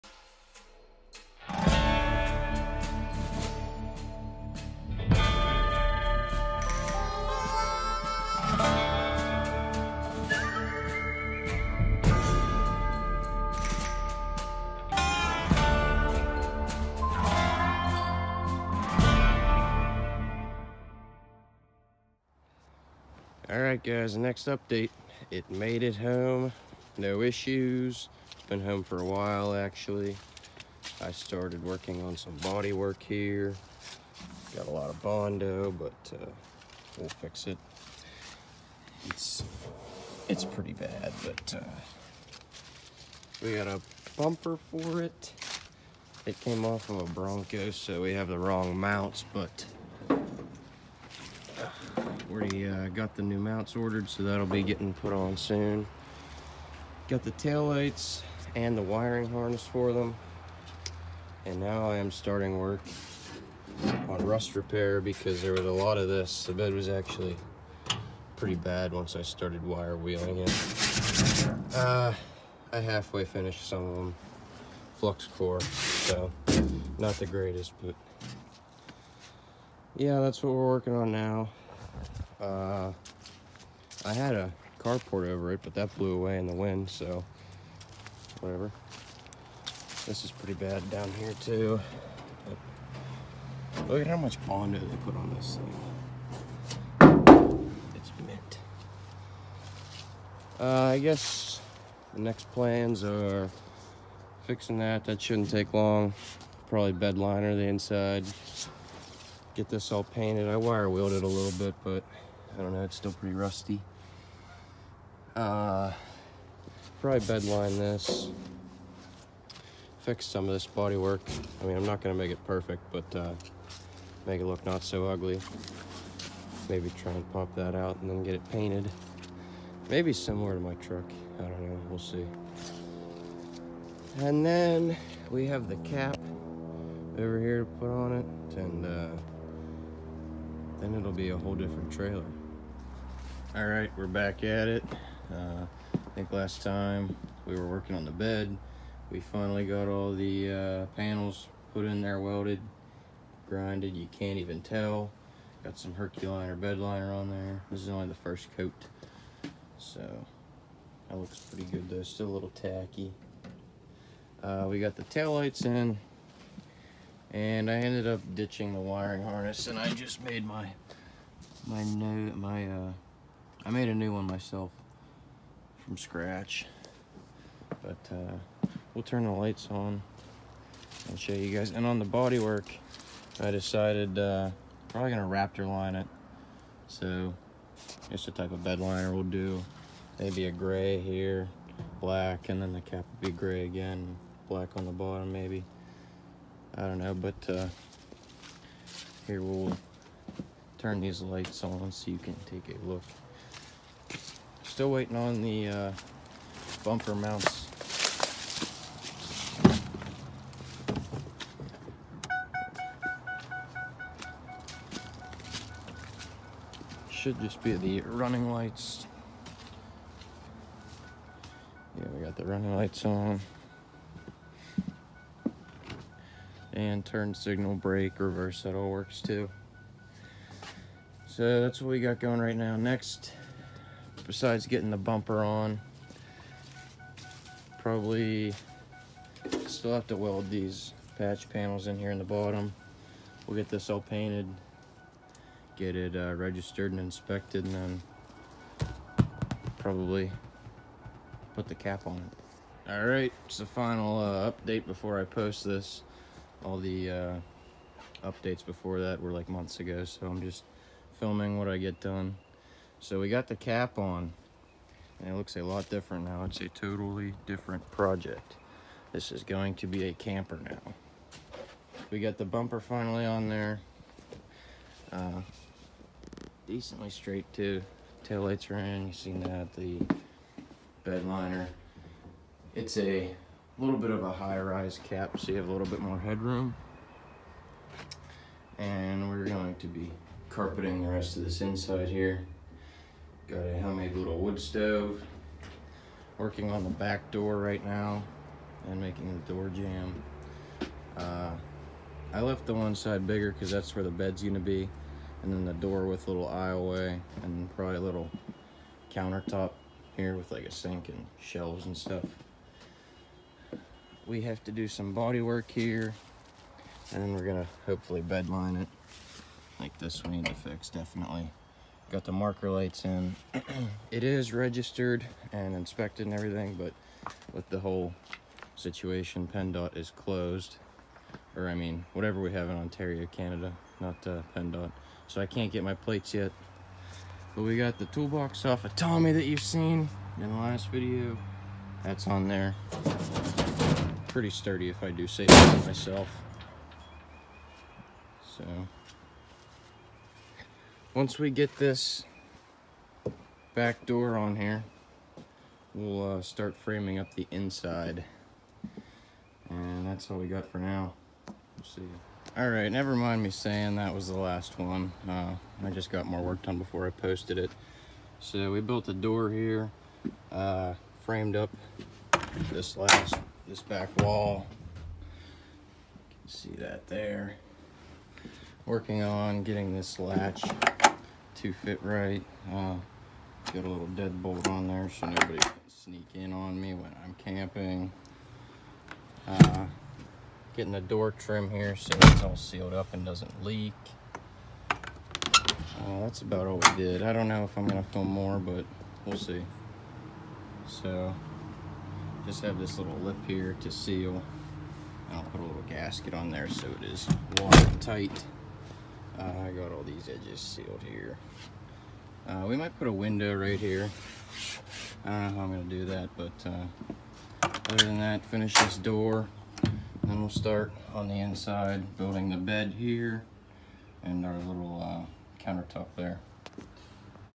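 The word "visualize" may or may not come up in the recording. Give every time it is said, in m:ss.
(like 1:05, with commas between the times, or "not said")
not said.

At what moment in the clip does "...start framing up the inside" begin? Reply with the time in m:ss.
5:56.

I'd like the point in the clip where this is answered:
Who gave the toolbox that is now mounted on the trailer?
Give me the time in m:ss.
5:38.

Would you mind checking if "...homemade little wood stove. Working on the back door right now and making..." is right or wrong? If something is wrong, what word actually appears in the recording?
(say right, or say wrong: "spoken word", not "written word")
right.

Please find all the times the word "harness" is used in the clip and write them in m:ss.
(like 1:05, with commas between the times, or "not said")
0:59, 2:49.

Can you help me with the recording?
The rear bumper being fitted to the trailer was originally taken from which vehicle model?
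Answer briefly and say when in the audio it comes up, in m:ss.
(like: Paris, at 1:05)
Bronco, at 0:47.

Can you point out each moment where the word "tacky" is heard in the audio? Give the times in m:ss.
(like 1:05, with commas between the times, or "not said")
2:42.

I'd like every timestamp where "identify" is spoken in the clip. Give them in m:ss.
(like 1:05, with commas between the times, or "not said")
not said.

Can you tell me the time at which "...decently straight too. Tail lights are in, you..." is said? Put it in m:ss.
4:36.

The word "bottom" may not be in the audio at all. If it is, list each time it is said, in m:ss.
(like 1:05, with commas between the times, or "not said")
3:14, 4:02.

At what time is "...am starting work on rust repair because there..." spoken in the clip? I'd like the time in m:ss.
1:01.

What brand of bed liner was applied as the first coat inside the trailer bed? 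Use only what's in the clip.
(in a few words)
Herculiner.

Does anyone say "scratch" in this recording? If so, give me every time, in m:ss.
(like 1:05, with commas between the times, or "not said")
2:55.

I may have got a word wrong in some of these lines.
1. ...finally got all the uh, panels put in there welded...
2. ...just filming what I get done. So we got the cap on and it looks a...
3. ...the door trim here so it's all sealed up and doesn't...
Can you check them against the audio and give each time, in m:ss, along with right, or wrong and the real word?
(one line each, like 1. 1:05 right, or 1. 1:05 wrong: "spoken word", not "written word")
1. 2:29 right
2. 4:20 right
3. 6:30 right.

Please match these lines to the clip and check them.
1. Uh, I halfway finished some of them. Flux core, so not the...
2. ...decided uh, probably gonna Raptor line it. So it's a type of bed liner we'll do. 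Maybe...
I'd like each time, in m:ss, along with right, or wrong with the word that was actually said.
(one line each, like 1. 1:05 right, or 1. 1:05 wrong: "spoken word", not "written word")
1. 1:11 right
2. 3:03 right.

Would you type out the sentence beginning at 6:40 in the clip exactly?
So, just have this little lip here to seal.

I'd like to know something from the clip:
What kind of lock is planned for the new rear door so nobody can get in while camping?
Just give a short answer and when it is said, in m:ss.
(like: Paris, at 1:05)
Deadbolt, at 6:24.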